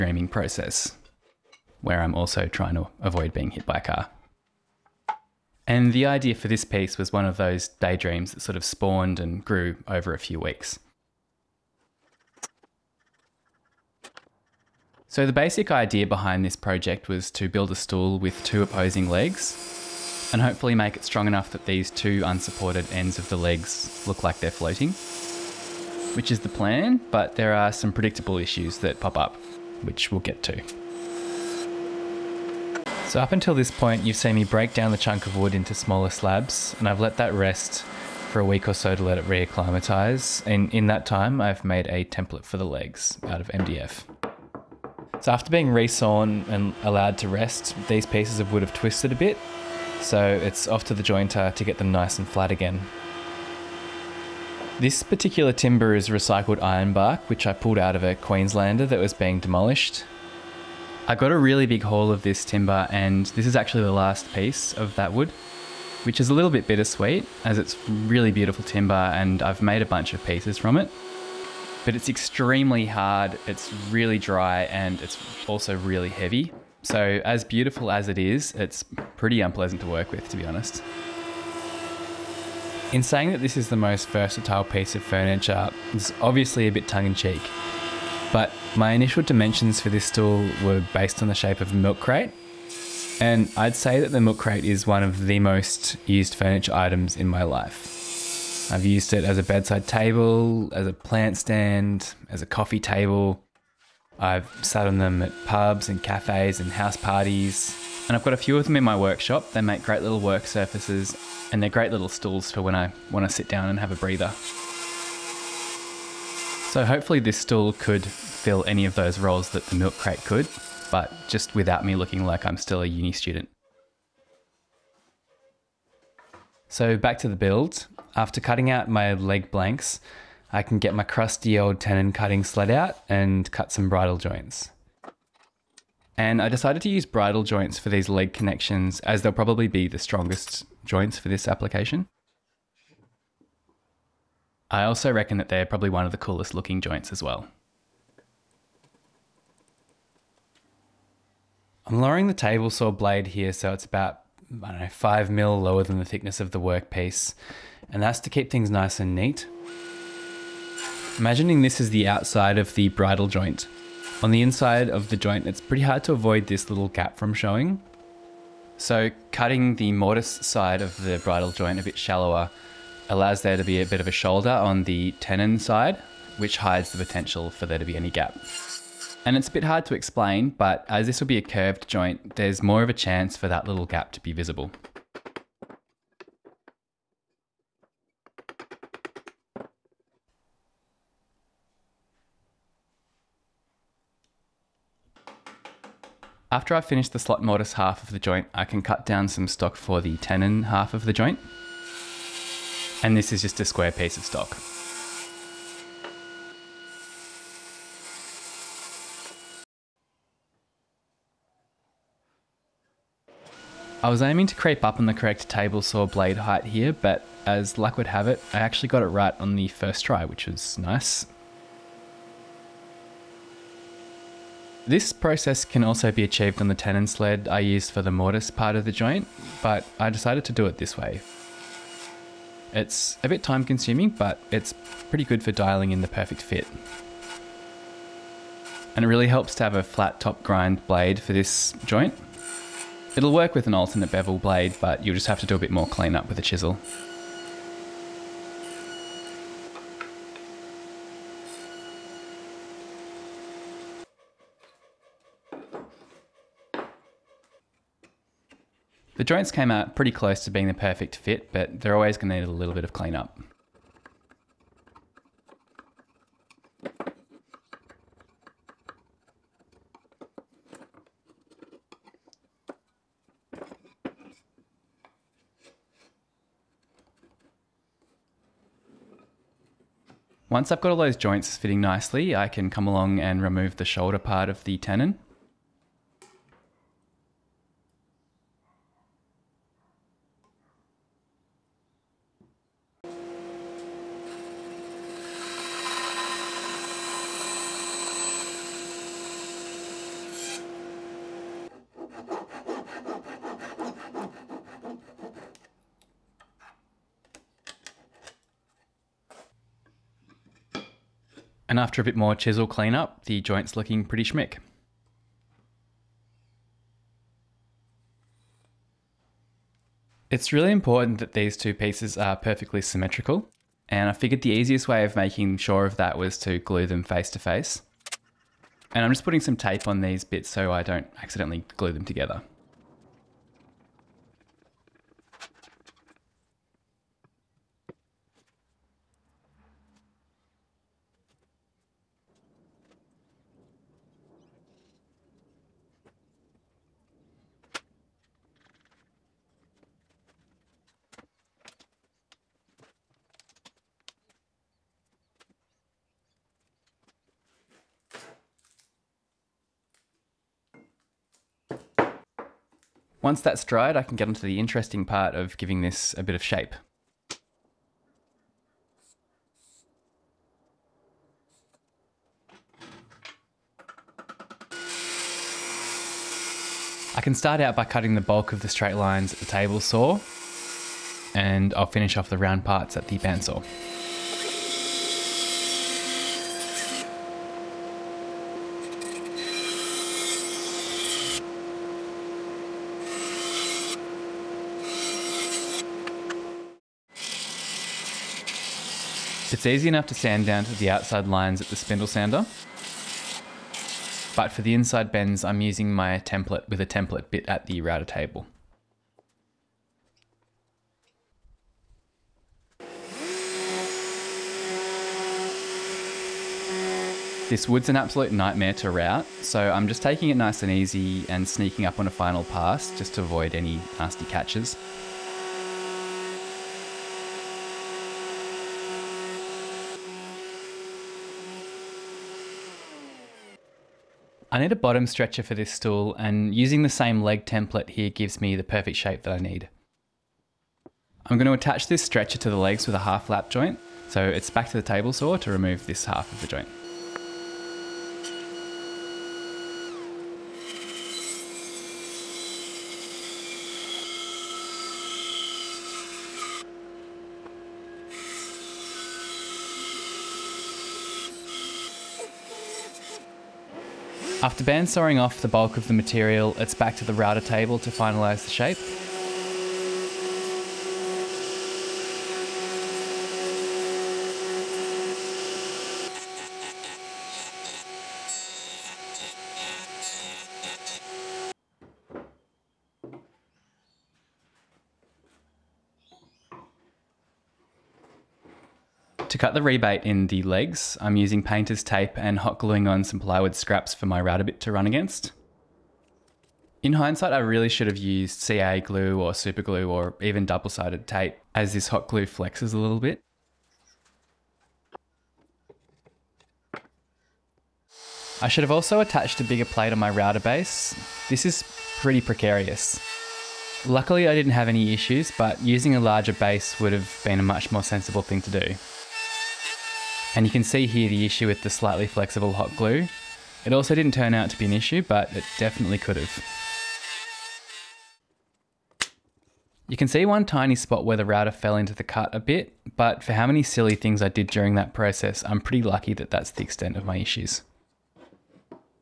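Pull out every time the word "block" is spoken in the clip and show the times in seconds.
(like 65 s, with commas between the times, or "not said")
not said.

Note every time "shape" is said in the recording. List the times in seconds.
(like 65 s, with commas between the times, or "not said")
91 s, 366 s, 438 s, 468 s.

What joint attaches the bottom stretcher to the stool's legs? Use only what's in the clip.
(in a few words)
Half lap joint.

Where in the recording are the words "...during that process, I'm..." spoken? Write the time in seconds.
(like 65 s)
534 s.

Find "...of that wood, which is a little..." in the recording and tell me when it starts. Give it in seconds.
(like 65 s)
64 s.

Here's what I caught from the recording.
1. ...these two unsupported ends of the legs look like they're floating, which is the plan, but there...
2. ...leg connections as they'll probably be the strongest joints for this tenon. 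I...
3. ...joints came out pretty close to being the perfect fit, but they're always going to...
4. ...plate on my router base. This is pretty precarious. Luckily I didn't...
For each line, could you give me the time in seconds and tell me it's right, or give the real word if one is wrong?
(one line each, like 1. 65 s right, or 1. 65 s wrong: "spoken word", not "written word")
1. 21 s right
2. 138 s wrong: "application", not "tenon"
3. 259 s right
4. 509 s right.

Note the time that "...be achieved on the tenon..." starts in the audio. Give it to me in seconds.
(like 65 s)
226 s.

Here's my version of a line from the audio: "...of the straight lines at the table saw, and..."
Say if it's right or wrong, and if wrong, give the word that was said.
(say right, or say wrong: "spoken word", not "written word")
right.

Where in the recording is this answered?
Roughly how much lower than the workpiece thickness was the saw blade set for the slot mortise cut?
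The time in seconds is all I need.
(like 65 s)
154 s.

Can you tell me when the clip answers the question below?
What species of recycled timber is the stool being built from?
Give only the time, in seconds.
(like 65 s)
56 s.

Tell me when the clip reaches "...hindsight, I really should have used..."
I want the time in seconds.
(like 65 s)
496 s.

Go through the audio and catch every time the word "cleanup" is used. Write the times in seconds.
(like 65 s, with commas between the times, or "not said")
245 s, 262 s, 312 s.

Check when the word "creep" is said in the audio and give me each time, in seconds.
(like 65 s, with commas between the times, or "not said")
214 s.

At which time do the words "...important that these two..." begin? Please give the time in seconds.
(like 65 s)
320 s.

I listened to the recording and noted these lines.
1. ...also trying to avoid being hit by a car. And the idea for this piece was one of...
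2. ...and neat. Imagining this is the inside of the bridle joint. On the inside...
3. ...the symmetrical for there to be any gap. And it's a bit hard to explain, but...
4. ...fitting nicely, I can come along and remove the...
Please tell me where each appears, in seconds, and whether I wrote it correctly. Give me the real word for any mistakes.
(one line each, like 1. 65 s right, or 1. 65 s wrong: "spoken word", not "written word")
1. 2 s right
2. 158 s wrong: "outside", not "inside"
3. 176 s wrong: "potential", not "symmetrical"
4. 281 s right.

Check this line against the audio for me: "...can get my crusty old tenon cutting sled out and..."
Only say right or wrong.
right.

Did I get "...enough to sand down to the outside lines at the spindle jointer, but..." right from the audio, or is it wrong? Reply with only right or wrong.
wrong.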